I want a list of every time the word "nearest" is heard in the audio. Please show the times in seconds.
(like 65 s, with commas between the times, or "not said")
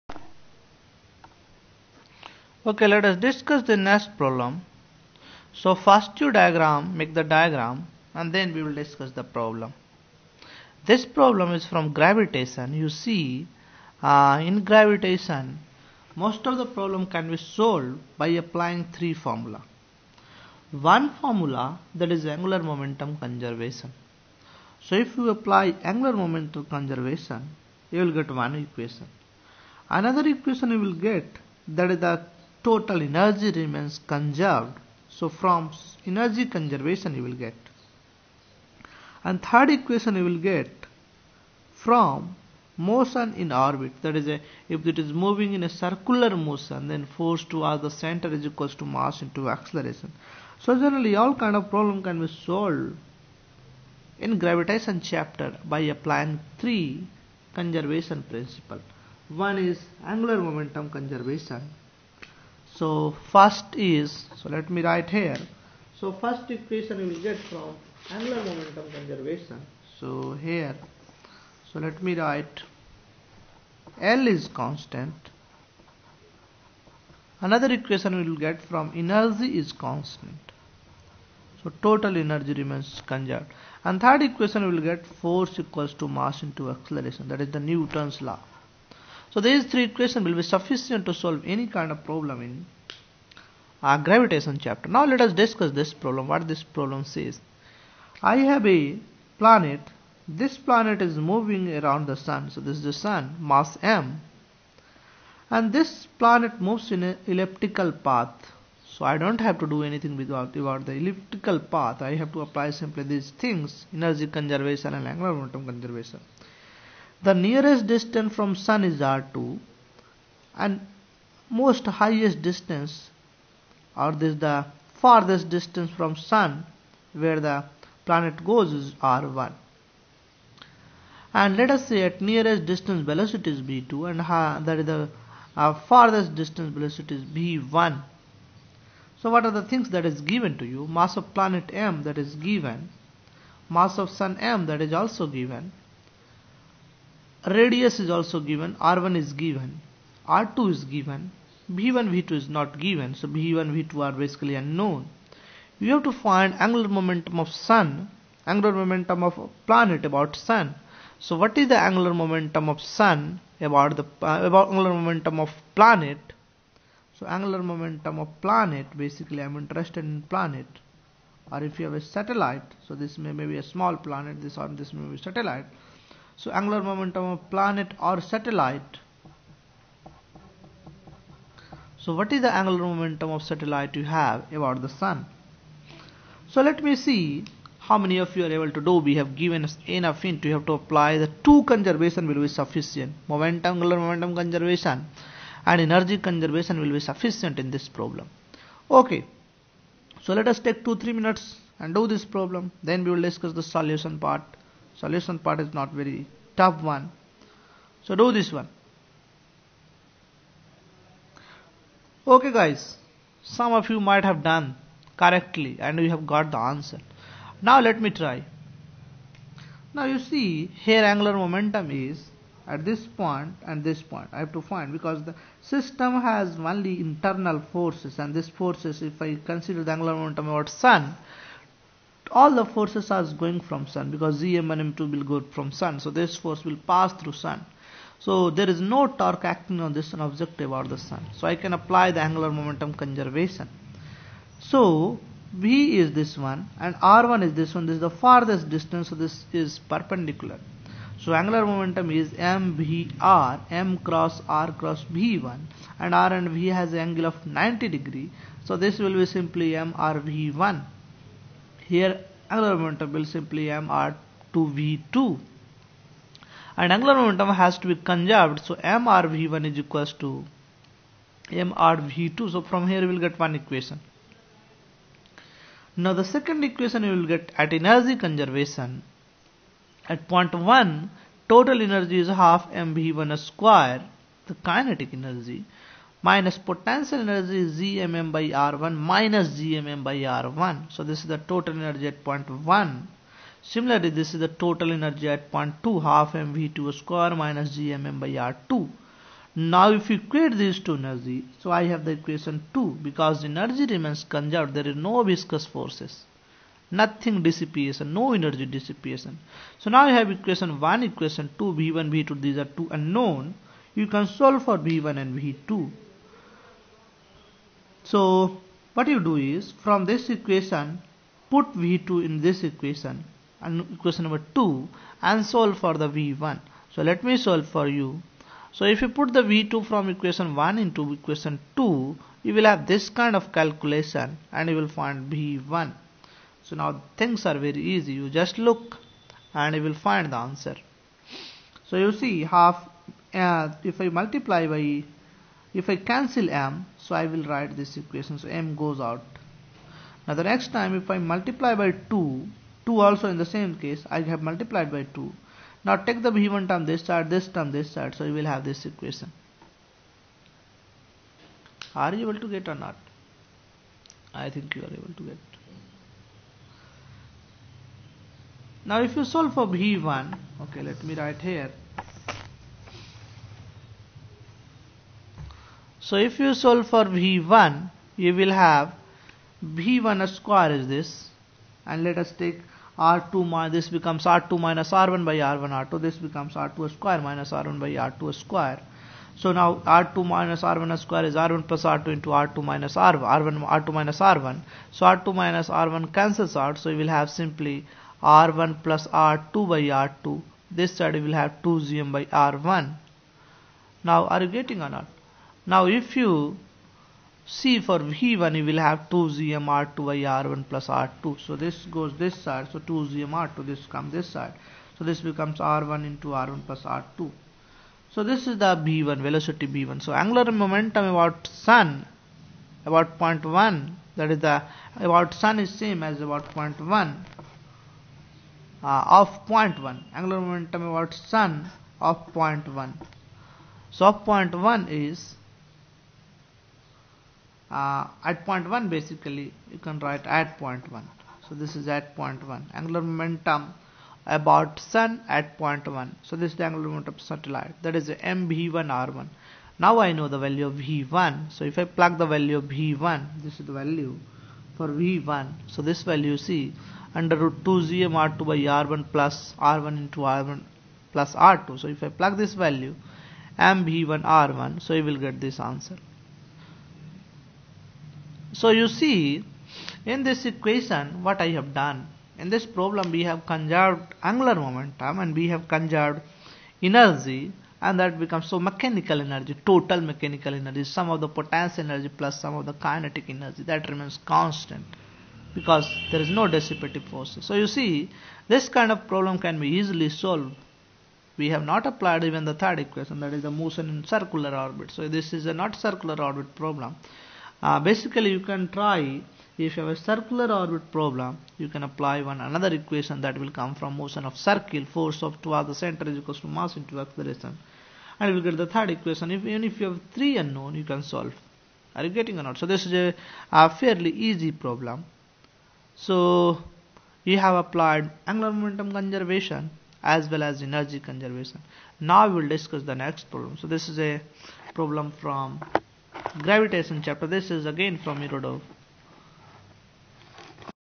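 117 s, 132 s.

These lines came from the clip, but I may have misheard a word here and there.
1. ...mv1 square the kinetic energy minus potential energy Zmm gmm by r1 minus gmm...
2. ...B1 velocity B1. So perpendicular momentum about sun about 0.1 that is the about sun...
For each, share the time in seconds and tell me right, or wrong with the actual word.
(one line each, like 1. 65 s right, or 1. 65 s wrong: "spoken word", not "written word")
1. 282 s right
2. 418 s wrong: "angular", not "perpendicular".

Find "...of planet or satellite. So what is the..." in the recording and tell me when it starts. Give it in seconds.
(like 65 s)
177 s.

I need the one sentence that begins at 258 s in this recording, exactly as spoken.
So this will be simply MRV1.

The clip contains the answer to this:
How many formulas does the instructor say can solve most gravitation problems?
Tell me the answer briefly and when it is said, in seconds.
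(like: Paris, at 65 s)
3, at 18 s.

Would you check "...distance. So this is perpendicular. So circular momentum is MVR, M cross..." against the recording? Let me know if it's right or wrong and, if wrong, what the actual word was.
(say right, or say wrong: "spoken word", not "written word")
wrong: "angular", not "circular".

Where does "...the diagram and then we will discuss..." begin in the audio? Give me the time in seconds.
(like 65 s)
7 s.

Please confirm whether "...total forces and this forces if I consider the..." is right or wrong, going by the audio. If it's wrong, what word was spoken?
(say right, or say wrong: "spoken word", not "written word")
wrong: "internal", not "total".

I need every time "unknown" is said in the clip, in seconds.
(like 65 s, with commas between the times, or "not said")
154 s, 312 s, 510 s.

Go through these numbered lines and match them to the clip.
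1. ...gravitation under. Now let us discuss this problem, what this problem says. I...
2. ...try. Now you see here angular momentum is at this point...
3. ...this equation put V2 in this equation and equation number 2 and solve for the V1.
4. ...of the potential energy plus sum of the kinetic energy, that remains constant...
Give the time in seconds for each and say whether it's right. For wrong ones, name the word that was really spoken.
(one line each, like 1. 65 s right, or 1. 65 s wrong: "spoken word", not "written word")
1. 93 s wrong: "chapter", not "under"
2. 218 s right
3. 320 s right
4. 481 s right.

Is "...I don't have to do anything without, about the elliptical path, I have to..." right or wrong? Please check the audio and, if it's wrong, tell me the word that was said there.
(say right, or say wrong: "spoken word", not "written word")
right.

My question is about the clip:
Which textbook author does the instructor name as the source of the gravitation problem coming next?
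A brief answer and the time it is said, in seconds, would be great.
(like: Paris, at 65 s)
Irodov, at 528 s.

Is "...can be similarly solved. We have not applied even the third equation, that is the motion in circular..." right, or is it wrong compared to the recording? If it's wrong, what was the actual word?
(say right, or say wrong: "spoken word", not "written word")
wrong: "easily", not "similarly".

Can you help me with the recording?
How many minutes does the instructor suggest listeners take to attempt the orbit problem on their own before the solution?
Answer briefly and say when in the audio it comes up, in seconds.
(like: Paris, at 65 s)
2-3 minutes, at 200 s.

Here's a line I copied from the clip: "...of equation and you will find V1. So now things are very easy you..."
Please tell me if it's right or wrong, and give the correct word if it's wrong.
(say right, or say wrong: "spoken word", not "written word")
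wrong: "calculation", not "equation".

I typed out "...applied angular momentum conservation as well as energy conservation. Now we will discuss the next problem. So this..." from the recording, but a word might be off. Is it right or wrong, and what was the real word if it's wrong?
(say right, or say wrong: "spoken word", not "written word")
right.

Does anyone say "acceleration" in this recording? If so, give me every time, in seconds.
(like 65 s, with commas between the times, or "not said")
49 s, 86 s, 506 s.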